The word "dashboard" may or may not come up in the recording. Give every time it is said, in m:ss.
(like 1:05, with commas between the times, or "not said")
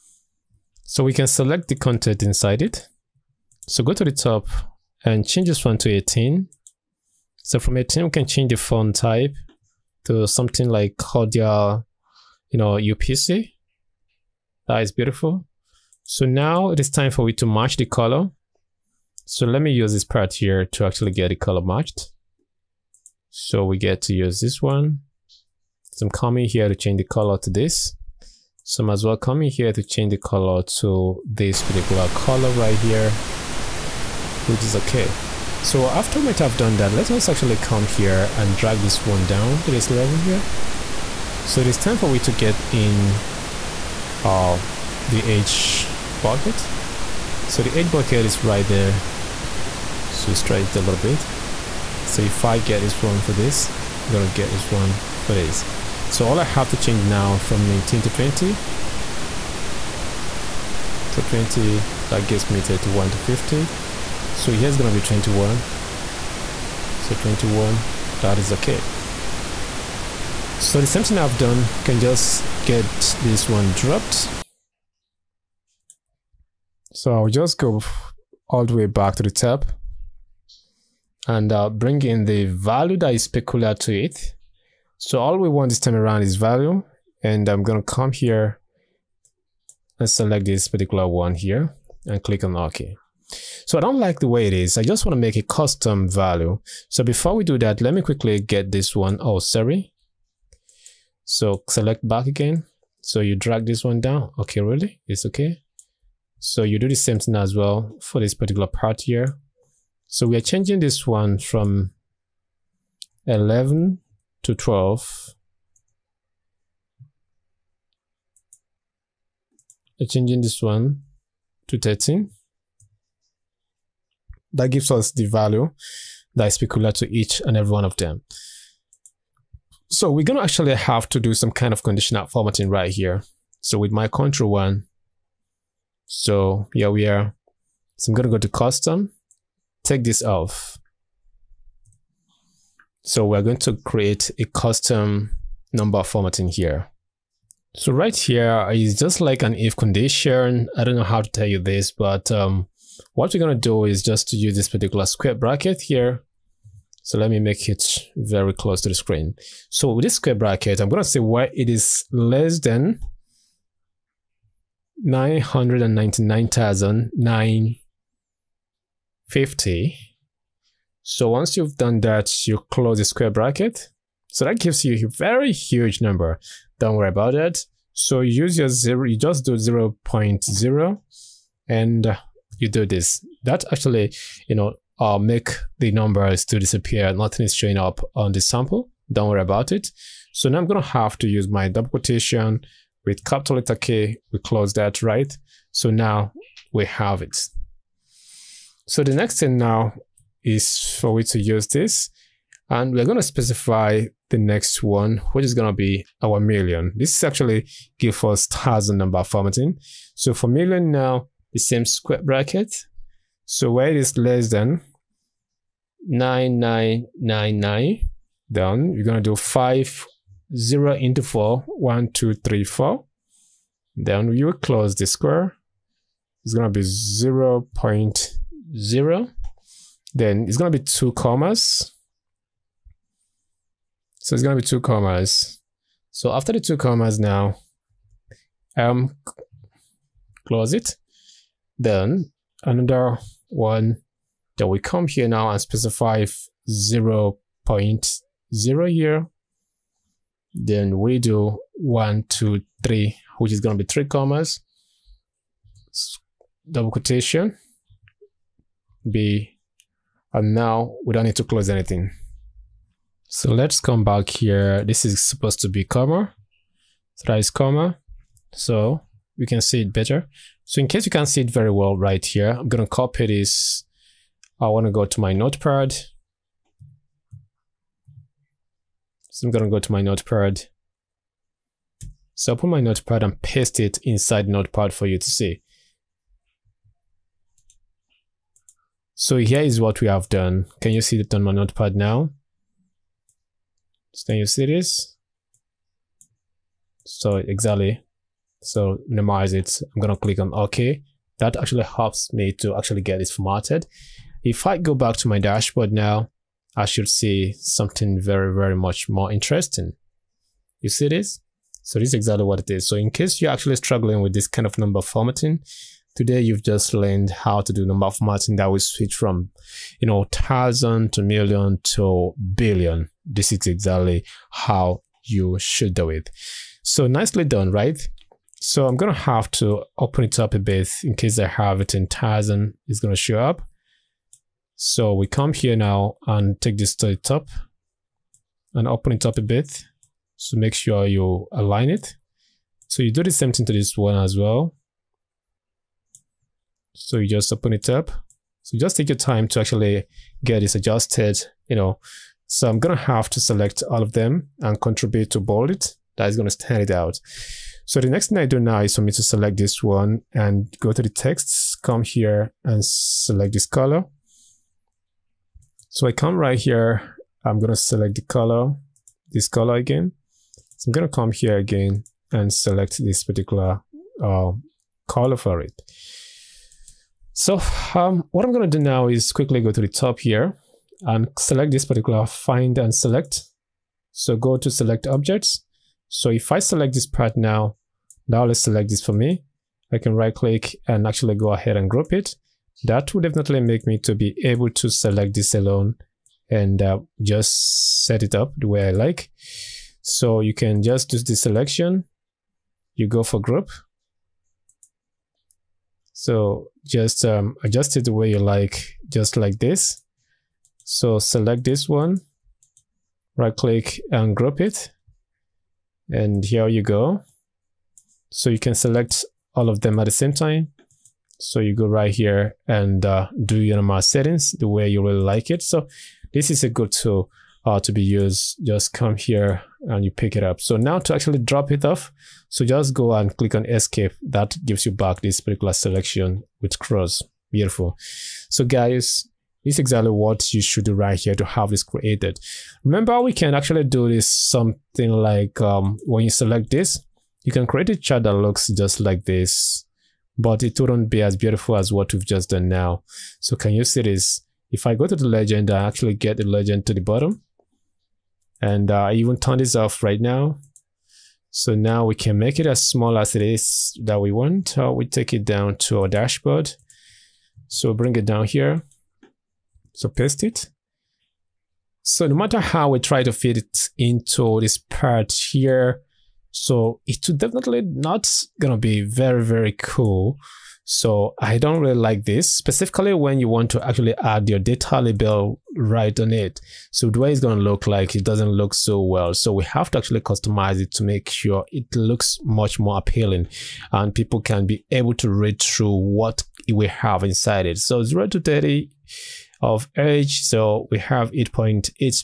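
5:05, 7:46.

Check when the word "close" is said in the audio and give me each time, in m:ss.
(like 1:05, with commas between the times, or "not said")
2:38, 2:52, 3:14, 3:44, 4:00, 4:21.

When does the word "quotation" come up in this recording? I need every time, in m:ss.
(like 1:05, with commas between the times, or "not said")
3:11, 4:16.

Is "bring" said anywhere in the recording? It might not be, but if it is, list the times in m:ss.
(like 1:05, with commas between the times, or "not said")
1:21, 7:47.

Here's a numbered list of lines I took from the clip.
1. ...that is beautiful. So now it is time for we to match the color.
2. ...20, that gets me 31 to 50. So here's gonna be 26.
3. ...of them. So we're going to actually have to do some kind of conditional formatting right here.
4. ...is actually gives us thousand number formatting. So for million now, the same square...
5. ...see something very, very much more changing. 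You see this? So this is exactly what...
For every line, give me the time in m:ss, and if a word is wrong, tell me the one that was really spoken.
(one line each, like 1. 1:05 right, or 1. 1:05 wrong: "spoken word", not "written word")
1. 0:14 right
2. 1:01 wrong: "21", not "26"
3. 2:07 right
4. 3:27 right
5. 5:07 wrong: "interesting", not "changing".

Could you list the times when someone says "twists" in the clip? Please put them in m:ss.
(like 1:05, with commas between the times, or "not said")
not said.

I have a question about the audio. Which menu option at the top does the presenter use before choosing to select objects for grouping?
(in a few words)
Find and Select.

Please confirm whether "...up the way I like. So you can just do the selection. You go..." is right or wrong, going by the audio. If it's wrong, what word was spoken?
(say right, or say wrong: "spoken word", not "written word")
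right.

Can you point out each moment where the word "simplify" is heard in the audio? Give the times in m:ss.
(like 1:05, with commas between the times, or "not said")
not said.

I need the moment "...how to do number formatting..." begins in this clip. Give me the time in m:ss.
5:17.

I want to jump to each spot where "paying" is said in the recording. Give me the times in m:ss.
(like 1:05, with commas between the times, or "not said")
not said.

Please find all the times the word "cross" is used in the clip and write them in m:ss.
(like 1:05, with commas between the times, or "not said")
7:16.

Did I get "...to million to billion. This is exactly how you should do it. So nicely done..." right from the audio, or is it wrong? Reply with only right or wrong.
right.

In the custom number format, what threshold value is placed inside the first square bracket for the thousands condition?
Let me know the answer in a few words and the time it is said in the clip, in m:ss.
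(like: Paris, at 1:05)
999,950, at 2:45.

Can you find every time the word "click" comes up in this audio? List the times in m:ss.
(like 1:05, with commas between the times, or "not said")
1:32, 5:00, 6:30, 6:53, 7:13.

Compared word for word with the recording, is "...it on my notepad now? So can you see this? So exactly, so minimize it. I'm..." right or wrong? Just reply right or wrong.
right.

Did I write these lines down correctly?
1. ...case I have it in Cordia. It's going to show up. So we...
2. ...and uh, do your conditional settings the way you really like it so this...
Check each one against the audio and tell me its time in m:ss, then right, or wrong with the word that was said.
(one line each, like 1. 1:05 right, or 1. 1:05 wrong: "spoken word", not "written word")
1. 5:31 wrong: "Tizen", not "Cordia"
2. 7:02 wrong: "normal", not "conditional".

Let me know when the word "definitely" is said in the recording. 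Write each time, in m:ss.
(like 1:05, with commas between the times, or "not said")
6:33, 7:57.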